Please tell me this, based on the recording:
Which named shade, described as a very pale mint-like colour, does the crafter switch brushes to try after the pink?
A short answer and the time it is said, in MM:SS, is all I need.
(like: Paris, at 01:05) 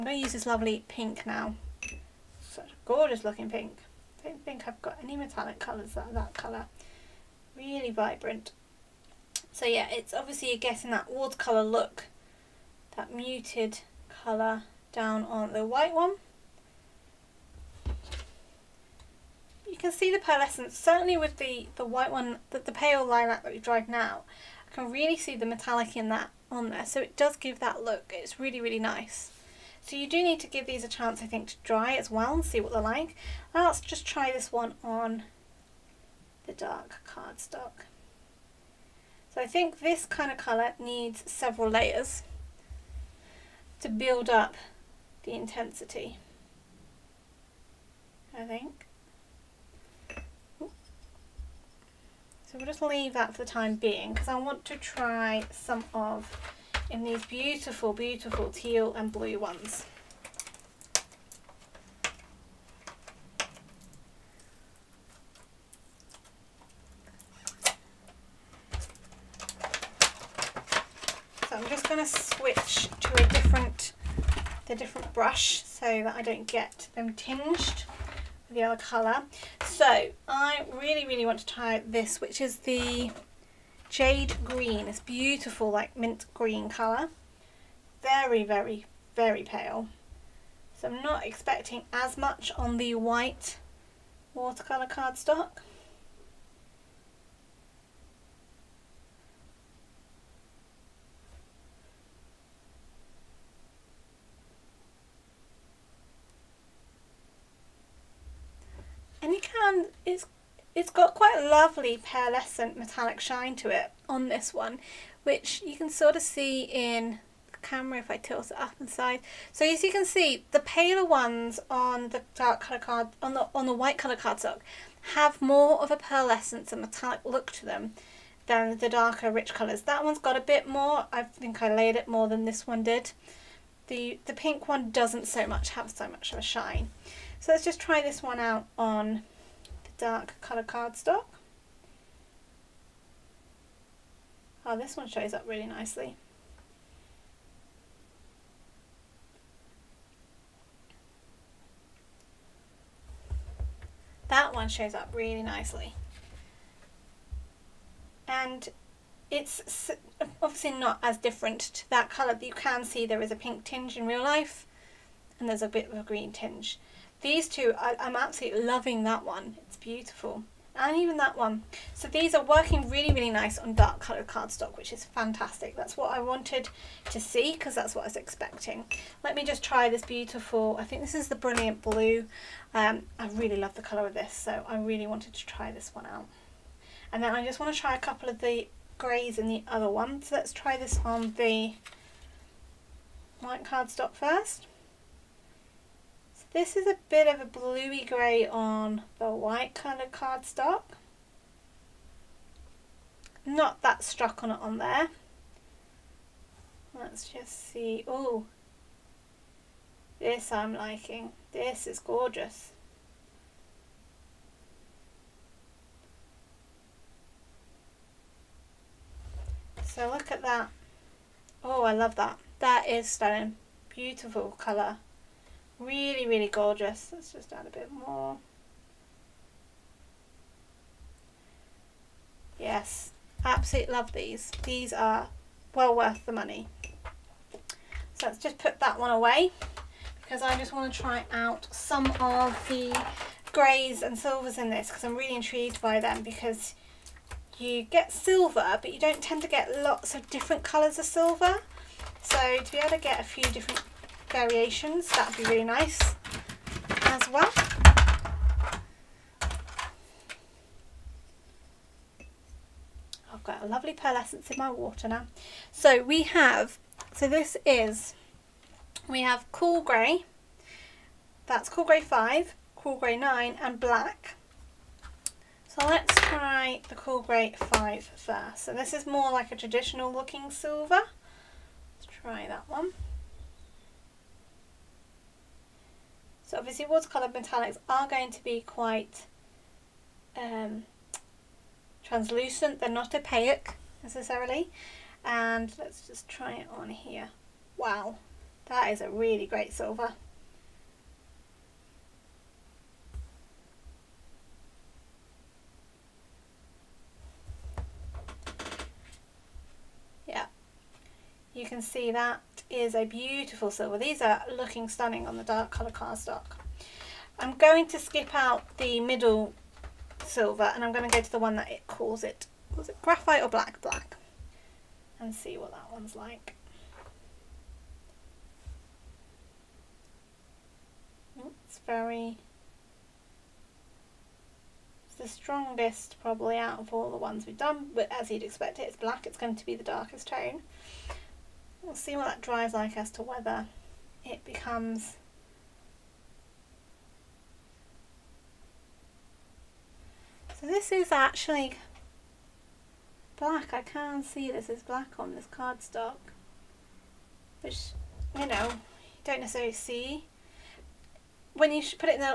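Jade Green, at 01:23.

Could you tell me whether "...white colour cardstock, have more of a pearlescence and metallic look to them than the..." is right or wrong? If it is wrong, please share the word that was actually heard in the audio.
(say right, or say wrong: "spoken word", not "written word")
right.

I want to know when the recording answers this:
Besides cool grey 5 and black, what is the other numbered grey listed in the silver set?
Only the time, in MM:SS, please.
04:32.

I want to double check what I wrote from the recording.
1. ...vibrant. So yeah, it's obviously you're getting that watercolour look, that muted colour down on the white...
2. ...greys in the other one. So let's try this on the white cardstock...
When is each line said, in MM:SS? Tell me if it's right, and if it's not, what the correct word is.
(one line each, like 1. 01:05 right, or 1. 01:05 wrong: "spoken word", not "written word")
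1. 00:07 right
2. 03:08 right.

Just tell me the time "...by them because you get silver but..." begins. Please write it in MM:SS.
04:05.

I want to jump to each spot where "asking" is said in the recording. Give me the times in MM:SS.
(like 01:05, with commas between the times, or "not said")
not said.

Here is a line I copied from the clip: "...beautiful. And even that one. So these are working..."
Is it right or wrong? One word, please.
right.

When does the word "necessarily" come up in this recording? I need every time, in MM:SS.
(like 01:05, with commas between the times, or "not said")
04:54, 05:59.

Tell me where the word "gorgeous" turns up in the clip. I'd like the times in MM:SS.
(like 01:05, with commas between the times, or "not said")
00:02, 03:31, 03:46.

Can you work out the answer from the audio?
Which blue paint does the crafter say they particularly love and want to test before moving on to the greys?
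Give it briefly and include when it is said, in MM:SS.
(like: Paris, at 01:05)
Brilliant Blue, at 03:01.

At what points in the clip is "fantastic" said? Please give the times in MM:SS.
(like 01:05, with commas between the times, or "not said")
02:55.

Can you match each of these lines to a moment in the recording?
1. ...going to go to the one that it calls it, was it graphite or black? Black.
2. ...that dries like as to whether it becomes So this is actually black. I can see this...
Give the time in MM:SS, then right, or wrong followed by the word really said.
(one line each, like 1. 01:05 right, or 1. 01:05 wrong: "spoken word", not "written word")
1. 05:20 right
2. 05:42 right.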